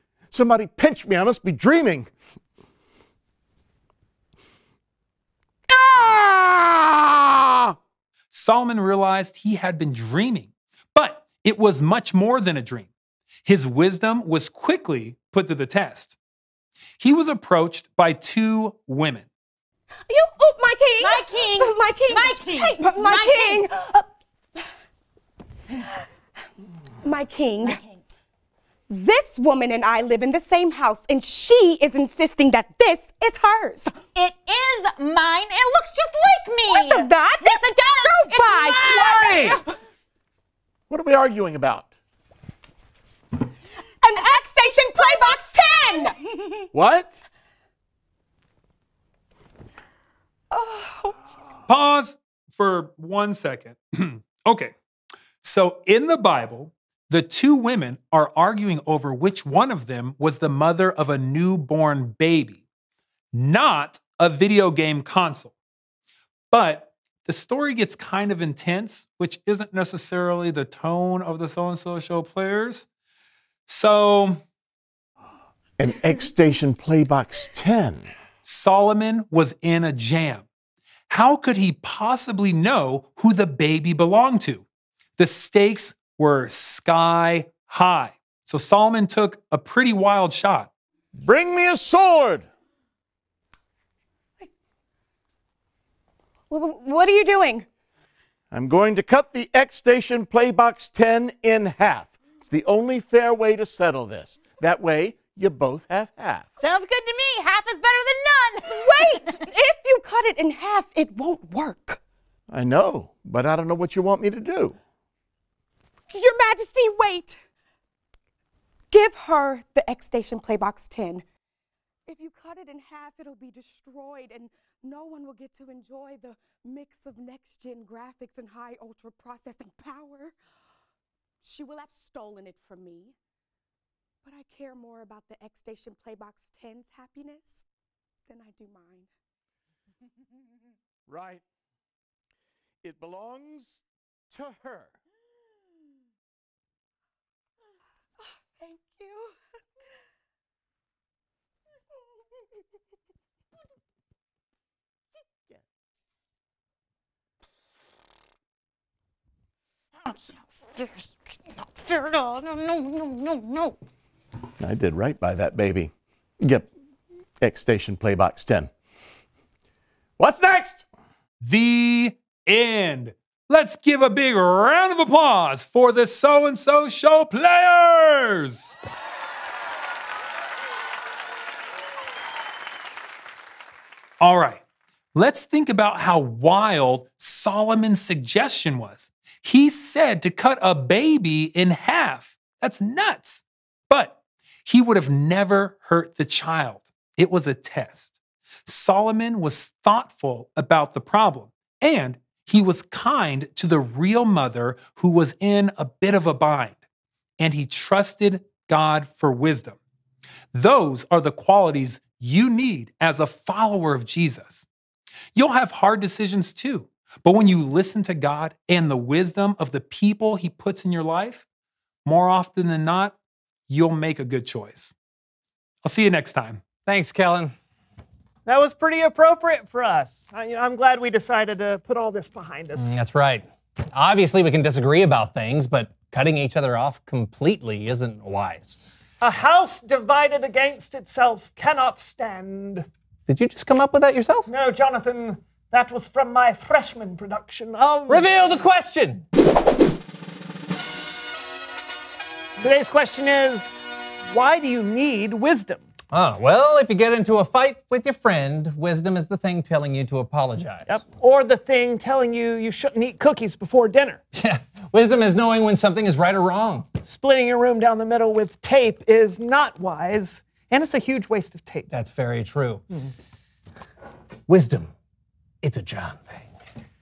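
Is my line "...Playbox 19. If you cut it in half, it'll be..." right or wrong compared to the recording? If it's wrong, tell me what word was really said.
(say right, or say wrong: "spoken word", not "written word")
wrong: "10", not "19".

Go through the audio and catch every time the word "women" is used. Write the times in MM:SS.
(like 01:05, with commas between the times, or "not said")
00:18, 00:57.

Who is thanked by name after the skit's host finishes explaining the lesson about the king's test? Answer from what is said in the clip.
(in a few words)
Kellen.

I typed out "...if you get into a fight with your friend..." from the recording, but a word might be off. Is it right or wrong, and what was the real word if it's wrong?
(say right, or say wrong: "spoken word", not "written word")
right.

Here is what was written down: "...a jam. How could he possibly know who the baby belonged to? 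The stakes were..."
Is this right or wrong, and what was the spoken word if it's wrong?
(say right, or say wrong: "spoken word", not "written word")
right.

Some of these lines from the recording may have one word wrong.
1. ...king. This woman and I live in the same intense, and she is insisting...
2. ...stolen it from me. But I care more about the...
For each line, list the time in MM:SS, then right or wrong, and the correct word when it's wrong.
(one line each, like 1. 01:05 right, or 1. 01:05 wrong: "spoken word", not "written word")
1. 00:27 wrong: "house", not "intense"
2. 02:11 right.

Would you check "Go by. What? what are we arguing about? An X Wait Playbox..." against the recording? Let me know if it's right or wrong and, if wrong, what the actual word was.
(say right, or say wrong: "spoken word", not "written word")
wrong: "Station", not "Wait".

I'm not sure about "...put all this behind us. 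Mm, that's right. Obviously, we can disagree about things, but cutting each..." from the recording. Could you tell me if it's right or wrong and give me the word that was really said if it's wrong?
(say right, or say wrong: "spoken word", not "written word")
right.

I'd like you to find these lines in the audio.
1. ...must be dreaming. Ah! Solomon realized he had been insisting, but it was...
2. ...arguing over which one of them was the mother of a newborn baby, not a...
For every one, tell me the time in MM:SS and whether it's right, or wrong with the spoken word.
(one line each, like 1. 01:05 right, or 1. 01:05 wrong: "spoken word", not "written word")
1. 00:01 wrong: "dreaming", not "insisting"
2. 00:58 right.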